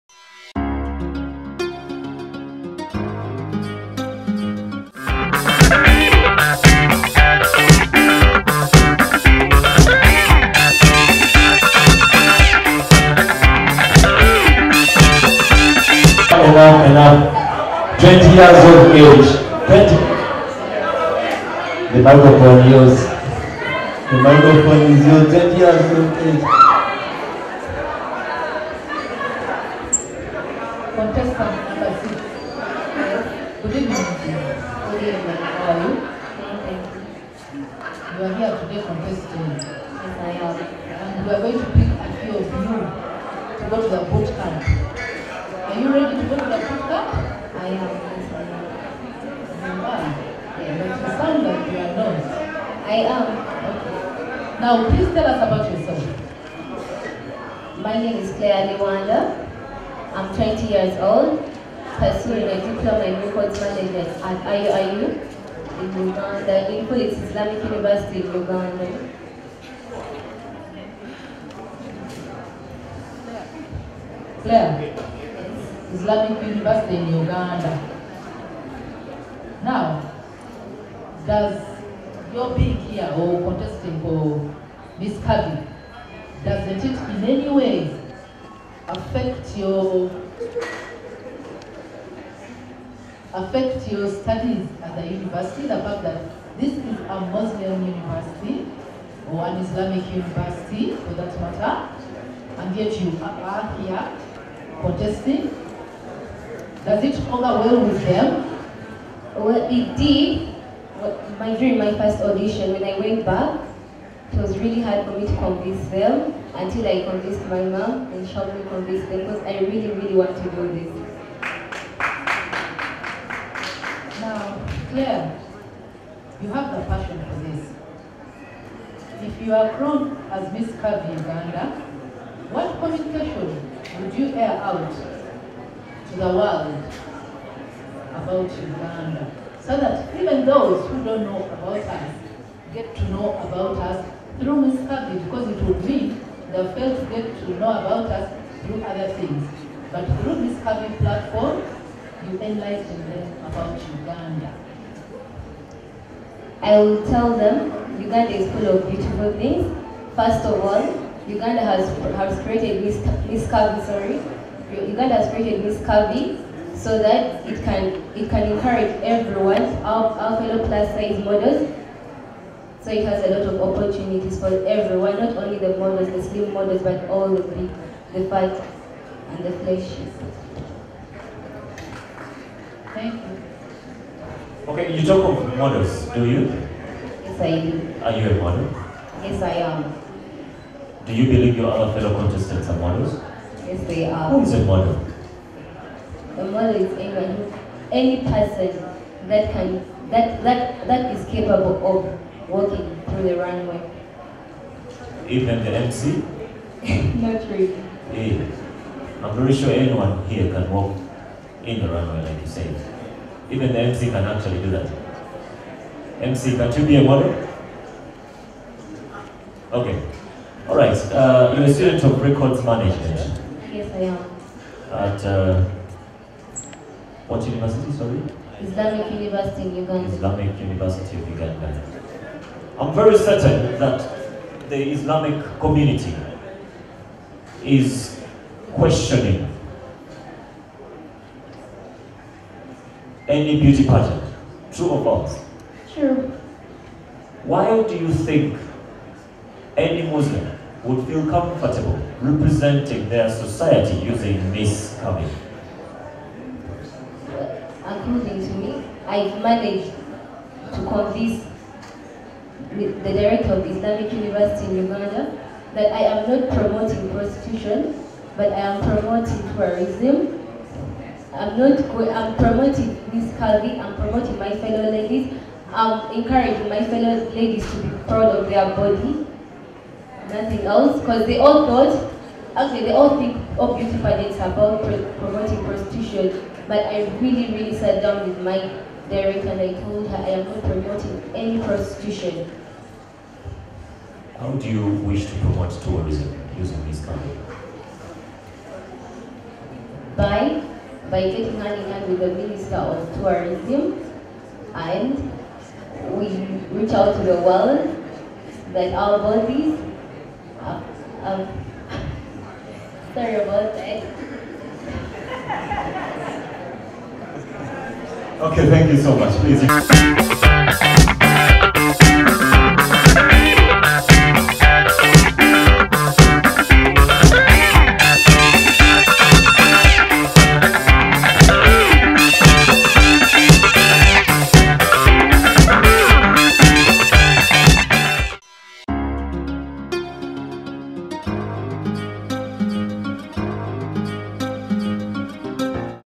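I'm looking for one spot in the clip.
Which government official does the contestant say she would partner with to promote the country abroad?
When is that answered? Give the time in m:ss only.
5:02.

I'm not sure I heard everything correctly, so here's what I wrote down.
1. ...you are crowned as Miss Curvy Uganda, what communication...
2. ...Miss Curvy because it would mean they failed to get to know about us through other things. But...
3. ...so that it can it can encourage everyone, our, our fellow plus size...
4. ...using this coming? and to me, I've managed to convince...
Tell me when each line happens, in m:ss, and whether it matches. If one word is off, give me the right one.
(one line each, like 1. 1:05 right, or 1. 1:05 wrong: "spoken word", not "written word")
1. 2:09 right
2. 2:24 right
3. 2:46 right
4. 4:14 right.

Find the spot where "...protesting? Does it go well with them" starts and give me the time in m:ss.
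1:44.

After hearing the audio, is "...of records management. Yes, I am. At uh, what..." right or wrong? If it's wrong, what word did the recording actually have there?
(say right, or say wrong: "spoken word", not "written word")
right.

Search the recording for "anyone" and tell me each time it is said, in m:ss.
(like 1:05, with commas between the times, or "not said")
3:17, 3:29.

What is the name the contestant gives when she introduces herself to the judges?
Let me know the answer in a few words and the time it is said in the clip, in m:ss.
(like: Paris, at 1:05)
Claire Liwanda, at 0:58.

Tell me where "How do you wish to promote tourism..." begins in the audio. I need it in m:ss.
4:54.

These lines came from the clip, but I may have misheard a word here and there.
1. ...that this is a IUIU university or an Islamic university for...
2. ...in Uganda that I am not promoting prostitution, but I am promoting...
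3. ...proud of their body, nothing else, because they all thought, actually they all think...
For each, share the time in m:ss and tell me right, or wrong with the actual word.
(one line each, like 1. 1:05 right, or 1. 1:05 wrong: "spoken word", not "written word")
1. 1:36 wrong: "Muslim", not "IUIU"
2. 4:24 right
3. 4:38 right.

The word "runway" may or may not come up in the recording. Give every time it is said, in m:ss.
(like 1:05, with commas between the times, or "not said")
3:23, 3:31.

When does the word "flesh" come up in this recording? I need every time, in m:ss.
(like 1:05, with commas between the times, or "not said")
2:59.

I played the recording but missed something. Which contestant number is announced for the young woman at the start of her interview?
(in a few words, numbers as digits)
6.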